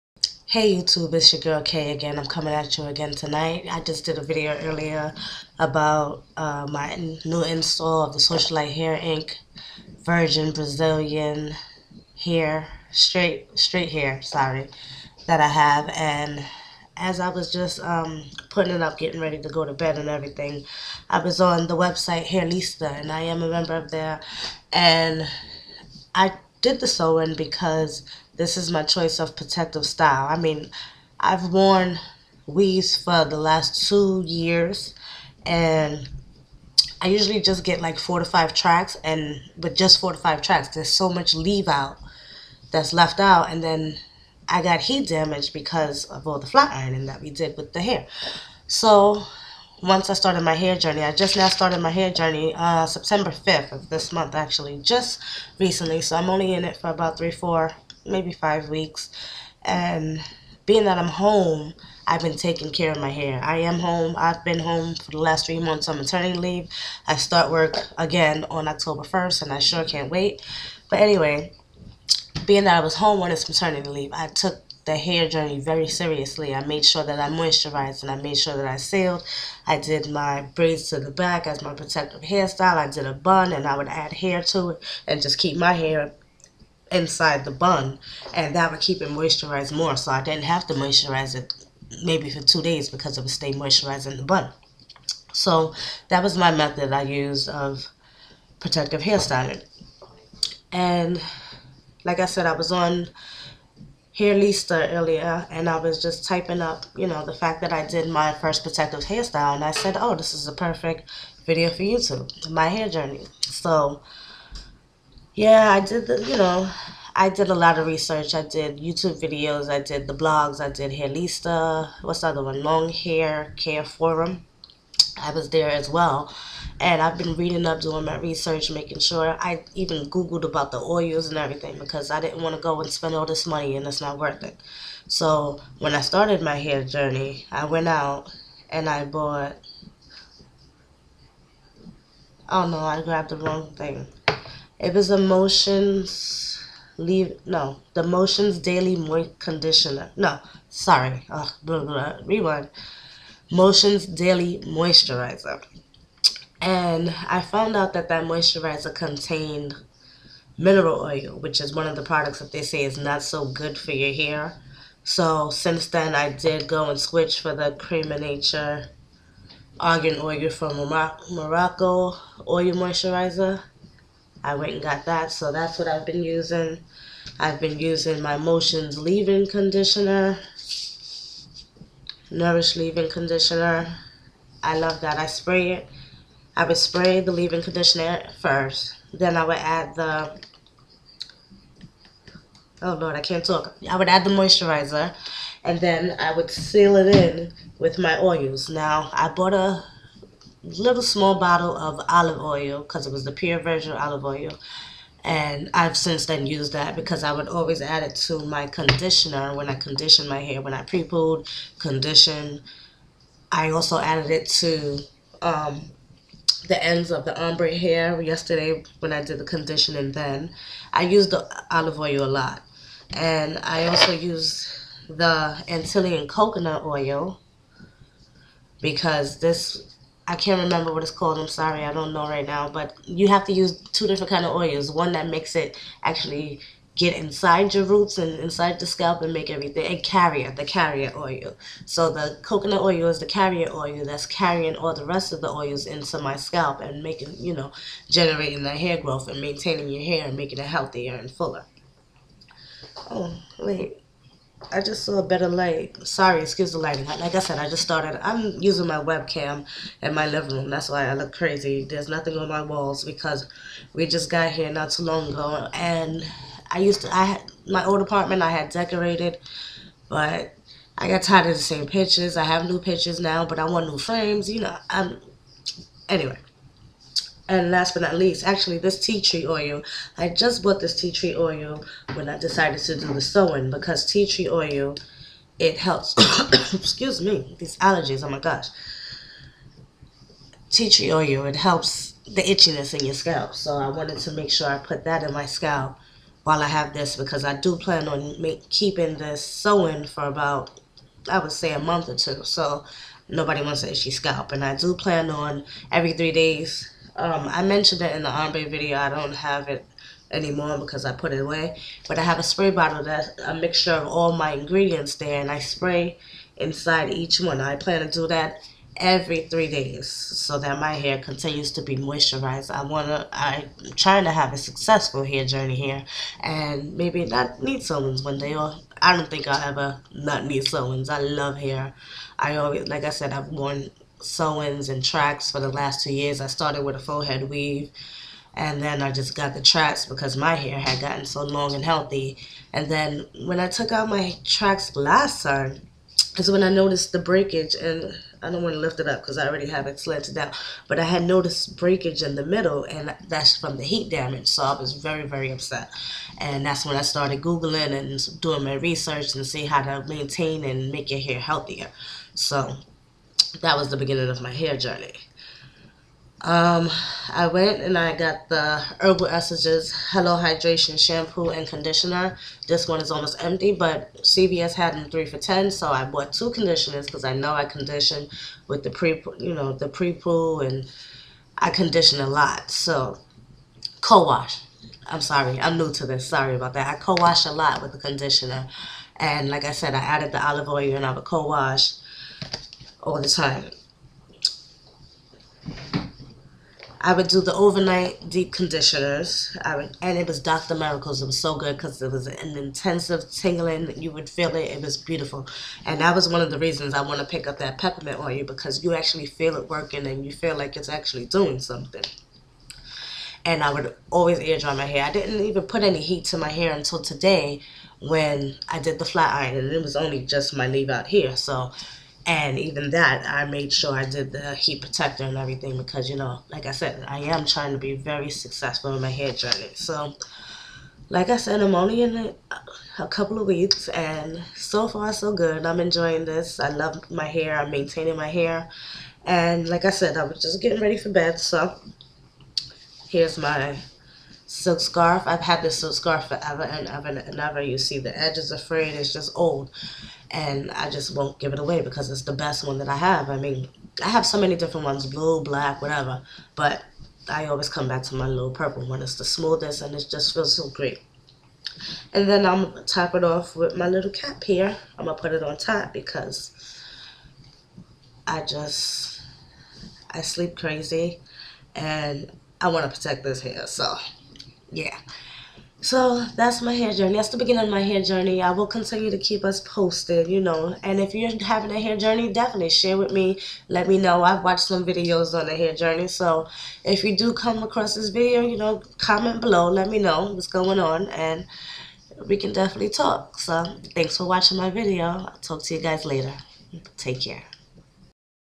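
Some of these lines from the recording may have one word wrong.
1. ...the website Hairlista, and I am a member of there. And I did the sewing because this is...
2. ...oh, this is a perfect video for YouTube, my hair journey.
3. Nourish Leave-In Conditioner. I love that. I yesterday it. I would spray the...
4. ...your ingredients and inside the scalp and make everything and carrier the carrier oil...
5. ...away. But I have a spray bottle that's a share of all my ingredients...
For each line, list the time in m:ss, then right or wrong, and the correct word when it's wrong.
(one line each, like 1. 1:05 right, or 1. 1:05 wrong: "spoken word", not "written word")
1. 0:21 right
2. 1:49 right
3. 3:02 wrong: "spray", not "yesterday"
4. 3:57 wrong: "roots", not "ingredients"
5. 5:11 wrong: "mixture", not "share".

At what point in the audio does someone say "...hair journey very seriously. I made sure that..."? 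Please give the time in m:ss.
1:14.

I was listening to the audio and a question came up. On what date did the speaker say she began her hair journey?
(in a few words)
September 5th.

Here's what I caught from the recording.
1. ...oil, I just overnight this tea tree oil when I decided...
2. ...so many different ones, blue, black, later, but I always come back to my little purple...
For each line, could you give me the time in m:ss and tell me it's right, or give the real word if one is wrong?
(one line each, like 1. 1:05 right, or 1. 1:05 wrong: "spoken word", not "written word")
1. 4:39 wrong: "bought", not "overnight"
2. 7:34 wrong: "whatever", not "later".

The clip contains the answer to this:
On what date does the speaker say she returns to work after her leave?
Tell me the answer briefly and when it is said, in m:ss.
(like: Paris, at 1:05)
October 1st, at 1:08.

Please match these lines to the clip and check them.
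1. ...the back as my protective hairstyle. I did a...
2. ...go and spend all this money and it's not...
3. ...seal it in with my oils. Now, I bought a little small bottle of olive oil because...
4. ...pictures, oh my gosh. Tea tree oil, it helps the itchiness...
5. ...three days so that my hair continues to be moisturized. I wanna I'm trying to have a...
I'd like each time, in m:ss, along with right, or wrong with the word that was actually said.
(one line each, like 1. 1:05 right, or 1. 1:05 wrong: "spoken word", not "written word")
1. 1:20 right
2. 2:12 right
3. 3:16 right
4. 4:47 wrong: "allergies", not "pictures"
5. 5:19 right.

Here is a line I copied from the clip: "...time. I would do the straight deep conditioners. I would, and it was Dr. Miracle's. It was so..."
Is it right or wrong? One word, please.
wrong.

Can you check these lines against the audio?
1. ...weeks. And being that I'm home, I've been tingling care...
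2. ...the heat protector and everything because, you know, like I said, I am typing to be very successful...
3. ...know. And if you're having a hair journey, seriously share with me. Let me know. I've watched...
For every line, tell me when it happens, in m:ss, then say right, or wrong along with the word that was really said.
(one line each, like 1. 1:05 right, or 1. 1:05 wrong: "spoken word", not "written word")
1. 0:58 wrong: "taking", not "tingling"
2. 7:04 wrong: "trying", not "typing"
3. 8:00 wrong: "definitely", not "seriously".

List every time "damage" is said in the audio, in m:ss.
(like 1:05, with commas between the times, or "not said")
0:45, 5:54.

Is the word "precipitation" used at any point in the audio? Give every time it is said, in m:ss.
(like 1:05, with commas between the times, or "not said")
not said.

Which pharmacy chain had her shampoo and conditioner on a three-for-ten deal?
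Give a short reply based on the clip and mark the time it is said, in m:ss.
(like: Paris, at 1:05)
CVS, at 6:14.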